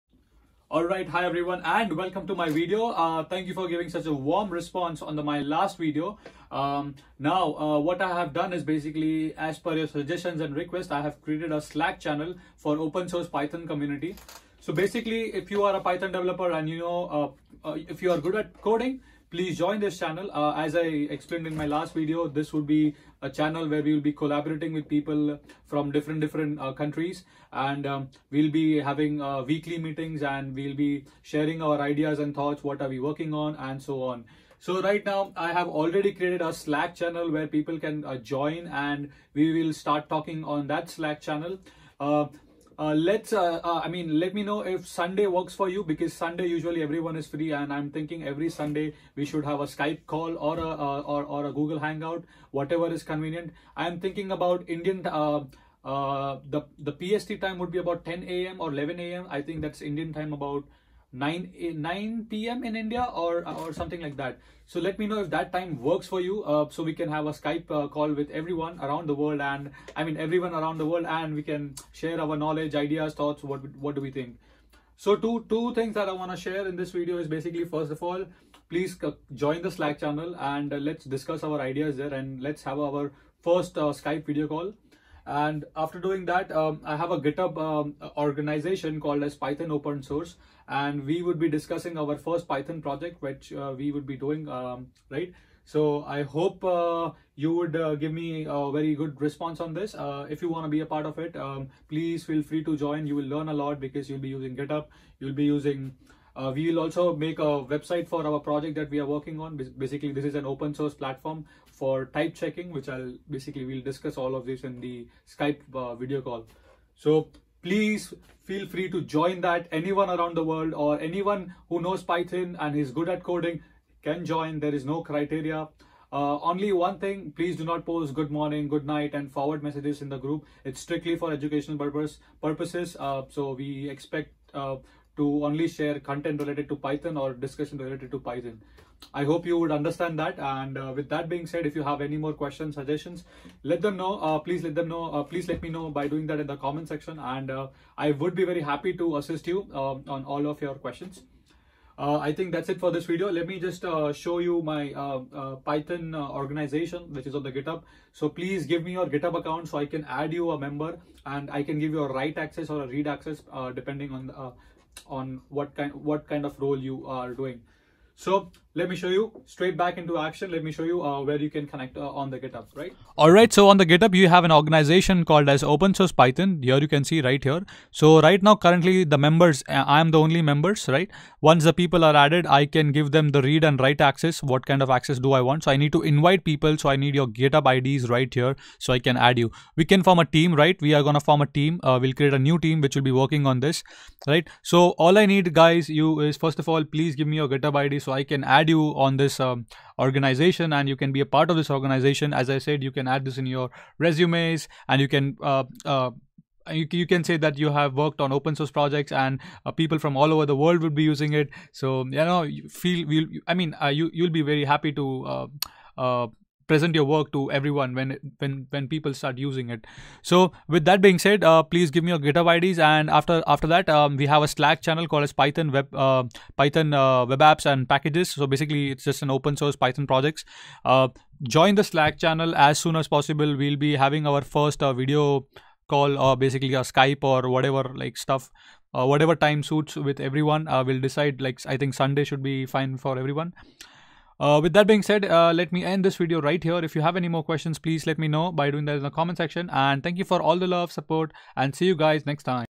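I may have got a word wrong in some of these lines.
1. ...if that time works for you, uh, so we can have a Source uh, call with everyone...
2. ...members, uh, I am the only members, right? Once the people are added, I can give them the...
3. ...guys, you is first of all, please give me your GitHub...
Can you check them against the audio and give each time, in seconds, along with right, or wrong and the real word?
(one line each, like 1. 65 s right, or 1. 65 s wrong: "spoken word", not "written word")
1. 65 s wrong: "Skype", not "Source"
2. 179 s right
3. 195 s right.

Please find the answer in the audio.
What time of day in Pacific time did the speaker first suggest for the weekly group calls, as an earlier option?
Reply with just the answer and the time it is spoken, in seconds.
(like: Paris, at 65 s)
10 a.m., at 58 s.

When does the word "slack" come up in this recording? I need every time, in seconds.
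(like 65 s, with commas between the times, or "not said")
11 s, 36 s, 40 s, 79 s, 224 s, 231 s.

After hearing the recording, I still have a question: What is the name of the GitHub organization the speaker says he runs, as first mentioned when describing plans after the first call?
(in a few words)
Python Open Source.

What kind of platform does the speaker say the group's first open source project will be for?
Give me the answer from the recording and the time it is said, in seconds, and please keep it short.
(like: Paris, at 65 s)
Type checking, at 112 s.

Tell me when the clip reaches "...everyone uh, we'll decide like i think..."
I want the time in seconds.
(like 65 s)
240 s.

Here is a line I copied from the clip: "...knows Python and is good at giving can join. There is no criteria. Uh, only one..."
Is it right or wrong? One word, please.
wrong.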